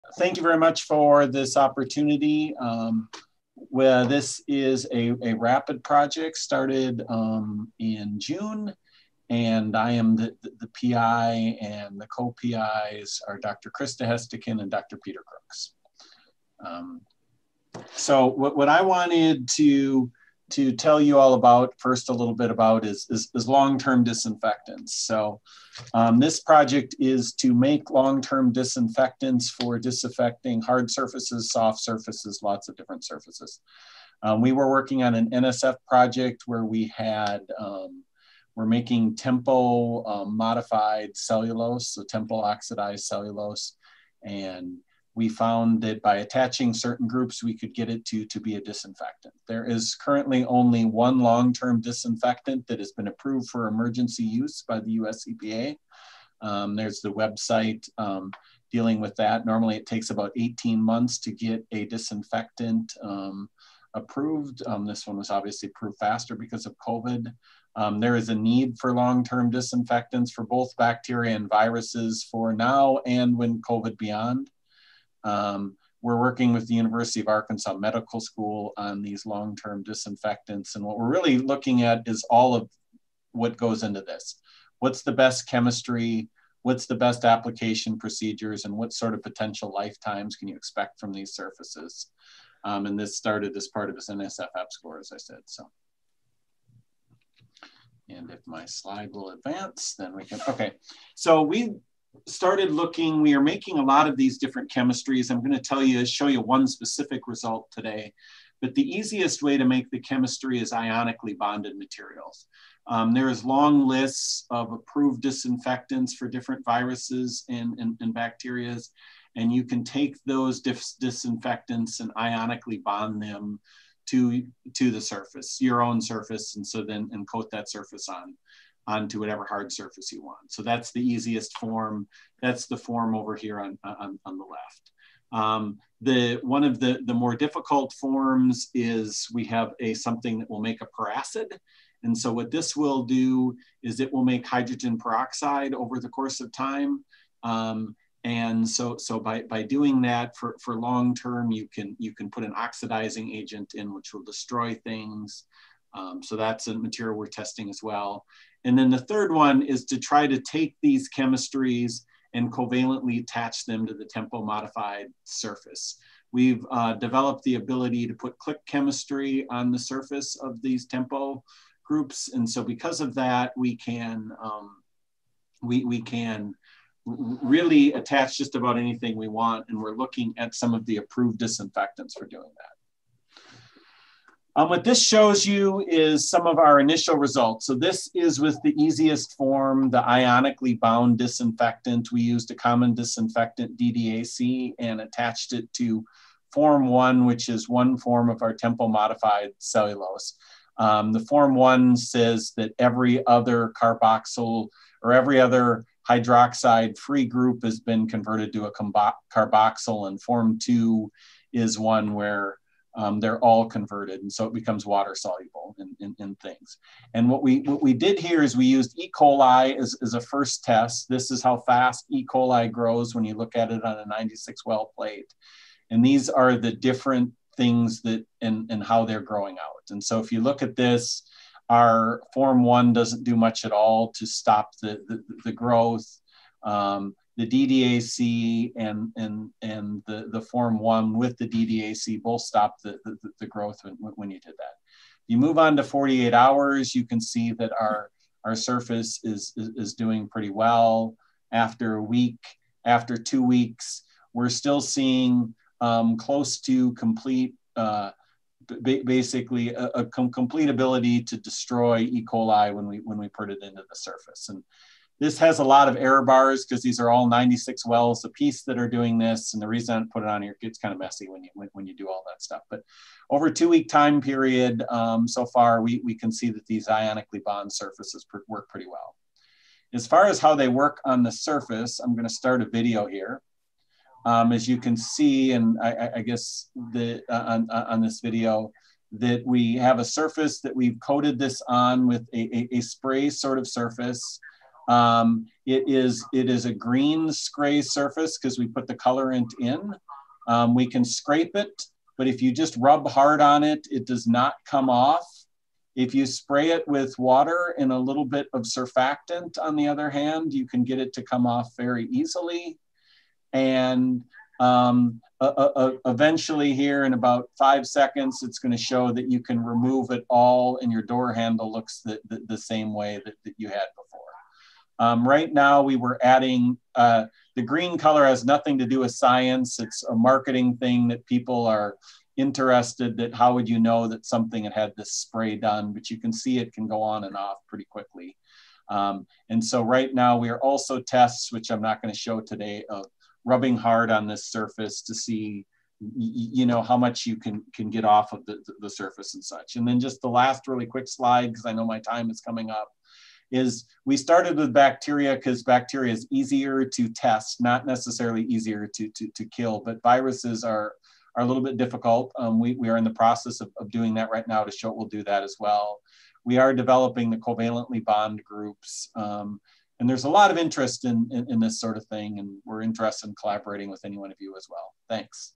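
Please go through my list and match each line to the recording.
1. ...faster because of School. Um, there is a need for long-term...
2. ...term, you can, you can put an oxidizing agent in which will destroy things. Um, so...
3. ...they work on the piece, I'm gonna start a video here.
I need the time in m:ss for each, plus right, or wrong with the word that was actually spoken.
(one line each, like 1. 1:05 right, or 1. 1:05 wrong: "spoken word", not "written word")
1. 1:05 wrong: "COVID", not "School"
2. 2:31 right
3. 4:40 wrong: "surface", not "piece".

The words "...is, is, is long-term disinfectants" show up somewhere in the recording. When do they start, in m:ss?
0:22.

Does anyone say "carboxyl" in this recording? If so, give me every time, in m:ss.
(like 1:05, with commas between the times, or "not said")
3:23, 3:29.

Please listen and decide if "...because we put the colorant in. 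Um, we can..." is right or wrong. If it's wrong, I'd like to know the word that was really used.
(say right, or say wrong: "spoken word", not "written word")
right.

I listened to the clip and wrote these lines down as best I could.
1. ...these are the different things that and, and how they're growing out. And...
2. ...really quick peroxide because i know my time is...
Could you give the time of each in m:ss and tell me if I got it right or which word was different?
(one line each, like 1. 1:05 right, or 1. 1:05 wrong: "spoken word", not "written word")
1. 3:46 right
2. 5:50 wrong: "slide", not "peroxide".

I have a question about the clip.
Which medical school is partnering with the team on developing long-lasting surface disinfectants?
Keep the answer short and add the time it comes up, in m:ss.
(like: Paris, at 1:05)
University of Arkansas Medical School, at 1:16.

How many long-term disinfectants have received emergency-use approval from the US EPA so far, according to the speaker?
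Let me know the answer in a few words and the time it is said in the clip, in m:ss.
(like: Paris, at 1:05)
1, at 0:50.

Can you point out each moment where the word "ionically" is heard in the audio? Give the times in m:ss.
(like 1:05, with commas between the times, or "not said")
1:50, 2:02, 3:10, 4:36.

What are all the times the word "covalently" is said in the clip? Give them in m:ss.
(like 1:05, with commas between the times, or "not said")
2:42, 6:07.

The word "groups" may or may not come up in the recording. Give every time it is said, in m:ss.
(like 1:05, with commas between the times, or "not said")
0:47, 2:51, 3:27, 6:08.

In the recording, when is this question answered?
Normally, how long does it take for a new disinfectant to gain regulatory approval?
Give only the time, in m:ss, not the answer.
1:00.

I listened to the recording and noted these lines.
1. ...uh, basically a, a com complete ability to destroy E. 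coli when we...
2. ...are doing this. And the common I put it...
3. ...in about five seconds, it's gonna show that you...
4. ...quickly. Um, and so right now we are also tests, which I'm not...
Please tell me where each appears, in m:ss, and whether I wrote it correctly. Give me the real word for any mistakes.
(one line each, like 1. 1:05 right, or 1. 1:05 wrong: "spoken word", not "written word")
1. 4:17 right
2. 4:28 wrong: "reason", not "common"
3. 5:17 right
4. 5:37 right.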